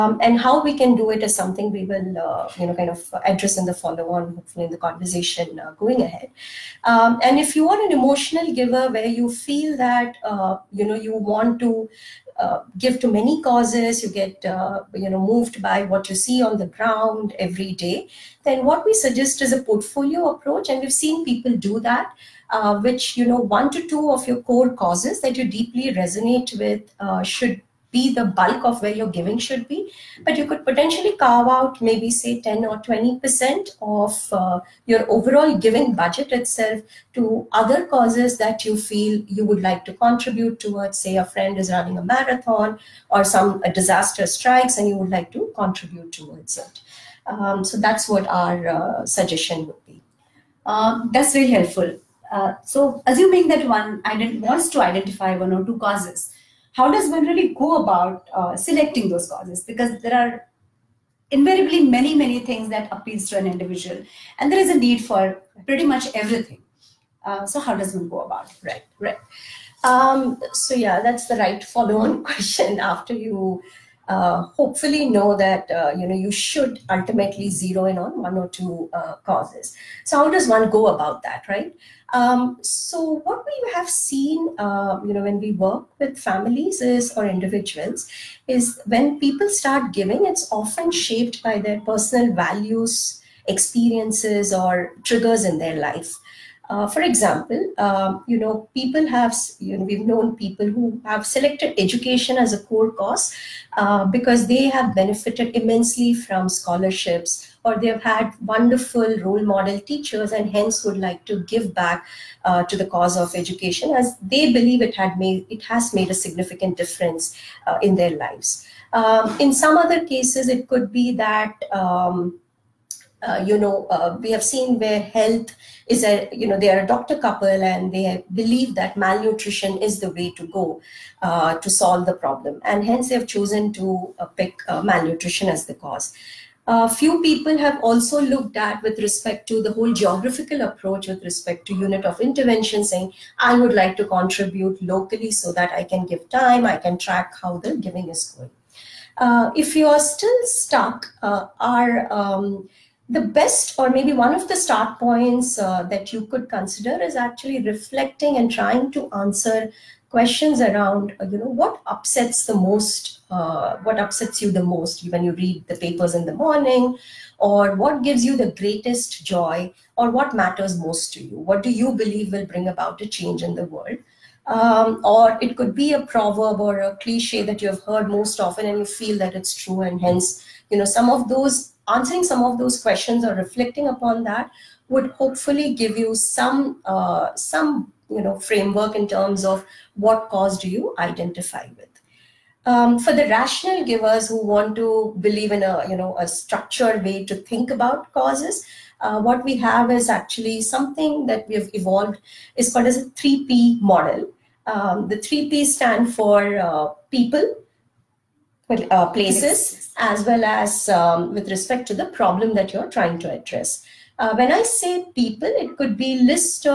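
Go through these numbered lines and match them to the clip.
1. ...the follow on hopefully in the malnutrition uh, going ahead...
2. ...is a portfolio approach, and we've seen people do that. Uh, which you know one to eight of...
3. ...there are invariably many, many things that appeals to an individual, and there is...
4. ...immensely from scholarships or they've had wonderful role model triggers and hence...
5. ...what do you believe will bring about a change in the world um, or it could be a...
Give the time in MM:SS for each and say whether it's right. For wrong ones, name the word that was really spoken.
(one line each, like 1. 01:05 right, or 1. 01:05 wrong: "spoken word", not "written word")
1. 00:03 wrong: "conversation", not "malnutrition"
2. 00:19 wrong: "two", not "eight"
3. 01:00 right
4. 01:45 wrong: "teachers", not "triggers"
5. 02:51 right.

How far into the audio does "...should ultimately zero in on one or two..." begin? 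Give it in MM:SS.
01:16.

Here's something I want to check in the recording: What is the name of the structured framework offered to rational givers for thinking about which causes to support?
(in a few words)
3P model.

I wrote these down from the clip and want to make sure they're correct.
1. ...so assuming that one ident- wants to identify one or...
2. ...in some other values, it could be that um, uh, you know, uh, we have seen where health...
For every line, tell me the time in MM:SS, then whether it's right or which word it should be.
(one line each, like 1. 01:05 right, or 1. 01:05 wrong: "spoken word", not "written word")
1. 00:52 right
2. 01:59 wrong: "cases", not "values".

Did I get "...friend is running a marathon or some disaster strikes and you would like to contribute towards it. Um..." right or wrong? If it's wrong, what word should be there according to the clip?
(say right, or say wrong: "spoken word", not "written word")
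right.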